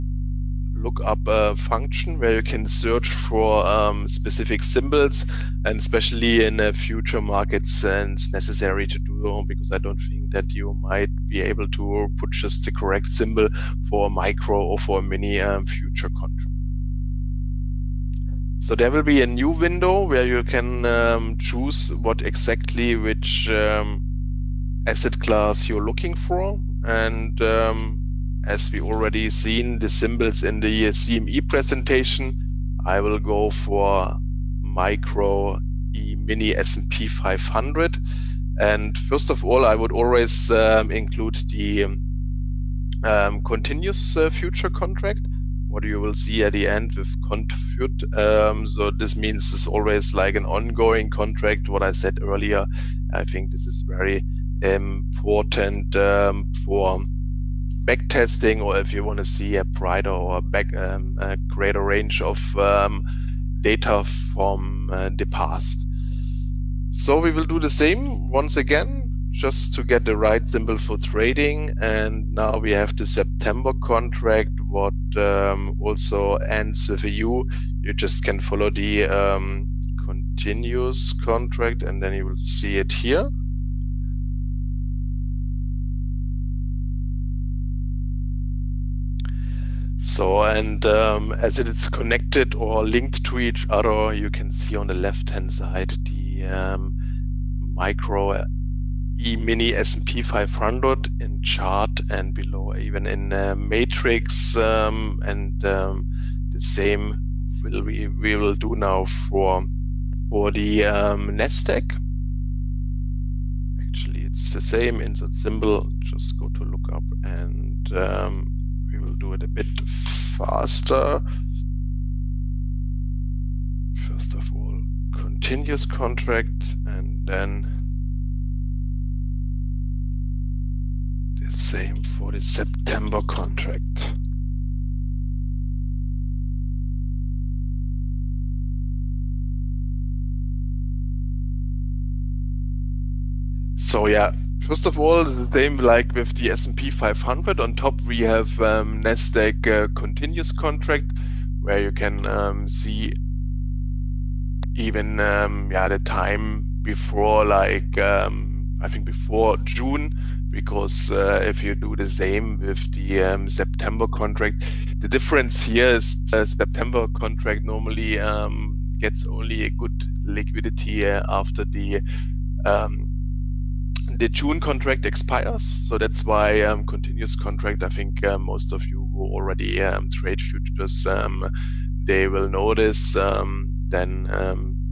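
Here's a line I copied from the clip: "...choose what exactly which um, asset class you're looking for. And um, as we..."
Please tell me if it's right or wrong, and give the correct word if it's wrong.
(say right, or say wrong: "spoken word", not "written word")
right.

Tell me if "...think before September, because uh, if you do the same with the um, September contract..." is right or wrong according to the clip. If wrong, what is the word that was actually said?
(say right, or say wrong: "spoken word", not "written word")
wrong: "June", not "September".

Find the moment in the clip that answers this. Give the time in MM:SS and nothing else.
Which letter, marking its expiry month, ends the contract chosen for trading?
01:17.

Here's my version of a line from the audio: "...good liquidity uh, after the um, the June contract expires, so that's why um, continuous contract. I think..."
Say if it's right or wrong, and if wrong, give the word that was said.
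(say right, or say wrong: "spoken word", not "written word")
right.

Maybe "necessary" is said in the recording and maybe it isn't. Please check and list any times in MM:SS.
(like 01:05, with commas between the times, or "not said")
00:08.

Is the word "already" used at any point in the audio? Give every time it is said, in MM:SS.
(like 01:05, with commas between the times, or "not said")
00:28, 02:59.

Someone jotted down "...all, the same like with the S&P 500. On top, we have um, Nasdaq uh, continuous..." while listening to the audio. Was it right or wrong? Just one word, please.
right.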